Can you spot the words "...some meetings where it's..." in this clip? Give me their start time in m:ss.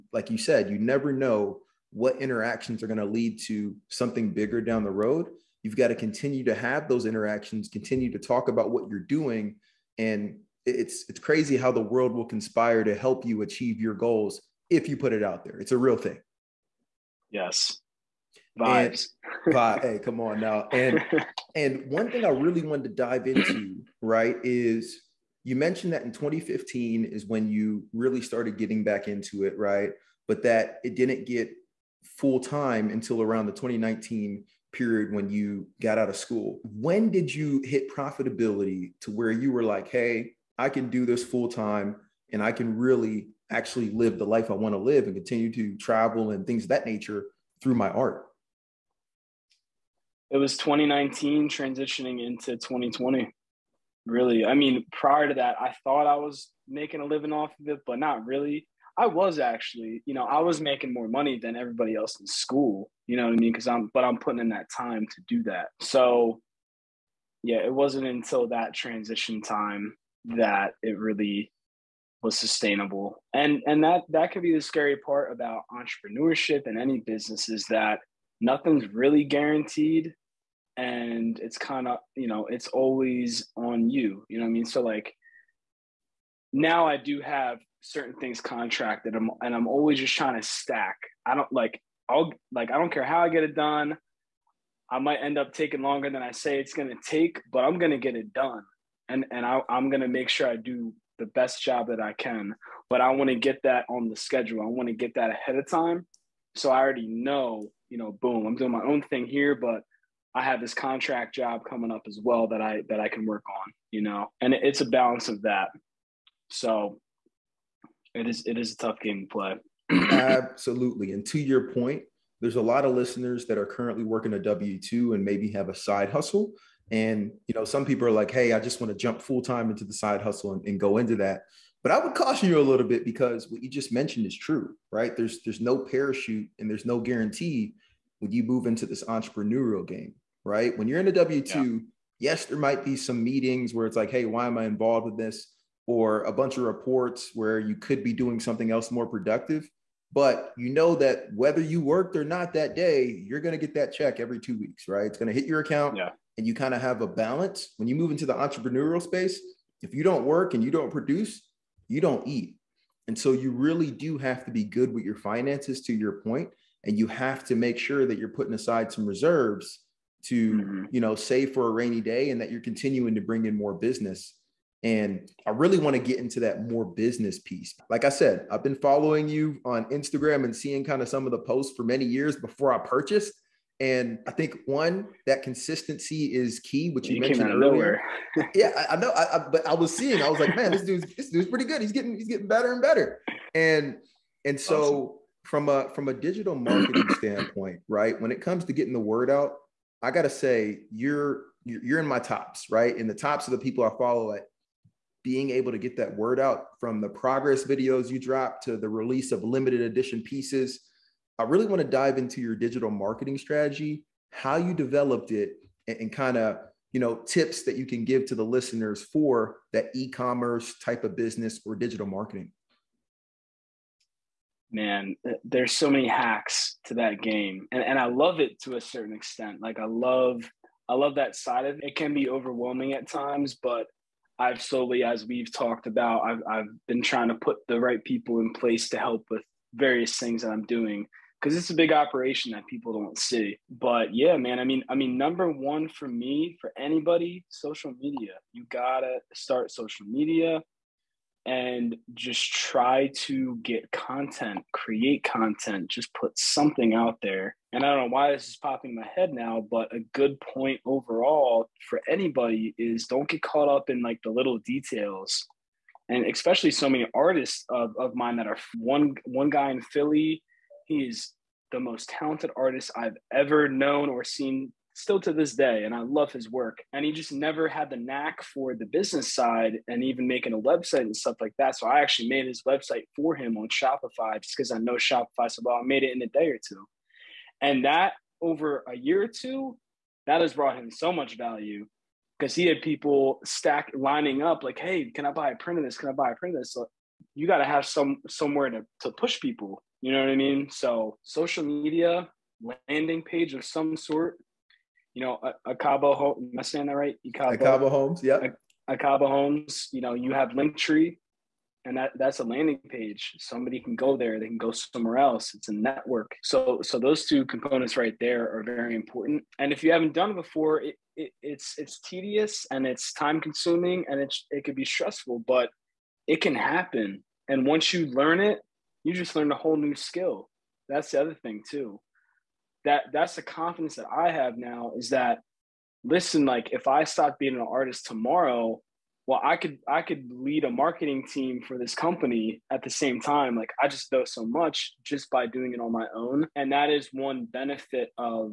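2:22.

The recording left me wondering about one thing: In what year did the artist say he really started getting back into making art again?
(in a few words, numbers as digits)
2015.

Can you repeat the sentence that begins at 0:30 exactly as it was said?
But that it didn't get full time until around the 2019 period when you got out of school.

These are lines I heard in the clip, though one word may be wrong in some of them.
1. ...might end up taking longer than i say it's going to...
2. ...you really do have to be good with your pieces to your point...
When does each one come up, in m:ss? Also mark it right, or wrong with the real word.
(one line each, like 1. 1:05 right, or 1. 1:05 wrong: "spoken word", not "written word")
1. 1:34 right
2. 2:43 wrong: "finances", not "pieces".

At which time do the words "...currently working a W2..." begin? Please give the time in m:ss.
2:03.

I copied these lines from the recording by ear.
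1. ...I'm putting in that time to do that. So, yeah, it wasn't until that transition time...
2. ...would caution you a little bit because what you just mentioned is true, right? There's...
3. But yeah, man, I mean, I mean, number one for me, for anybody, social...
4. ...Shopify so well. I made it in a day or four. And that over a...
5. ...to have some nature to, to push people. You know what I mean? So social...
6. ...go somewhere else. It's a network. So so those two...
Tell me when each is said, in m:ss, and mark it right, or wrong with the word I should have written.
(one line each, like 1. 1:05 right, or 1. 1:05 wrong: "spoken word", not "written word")
1. 1:04 right
2. 2:12 right
3. 4:03 right
4. 4:44 wrong: "two", not "four"
5. 4:57 wrong: "somewhere", not "nature"
6. 5:14 right.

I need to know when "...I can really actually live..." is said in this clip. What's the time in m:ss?
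0:42.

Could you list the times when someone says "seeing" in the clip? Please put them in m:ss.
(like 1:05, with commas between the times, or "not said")
3:00, 3:09.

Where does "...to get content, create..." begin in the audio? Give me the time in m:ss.
4:13.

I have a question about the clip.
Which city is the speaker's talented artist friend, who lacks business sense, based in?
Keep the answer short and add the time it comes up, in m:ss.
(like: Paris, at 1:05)
Philly, at 4:29.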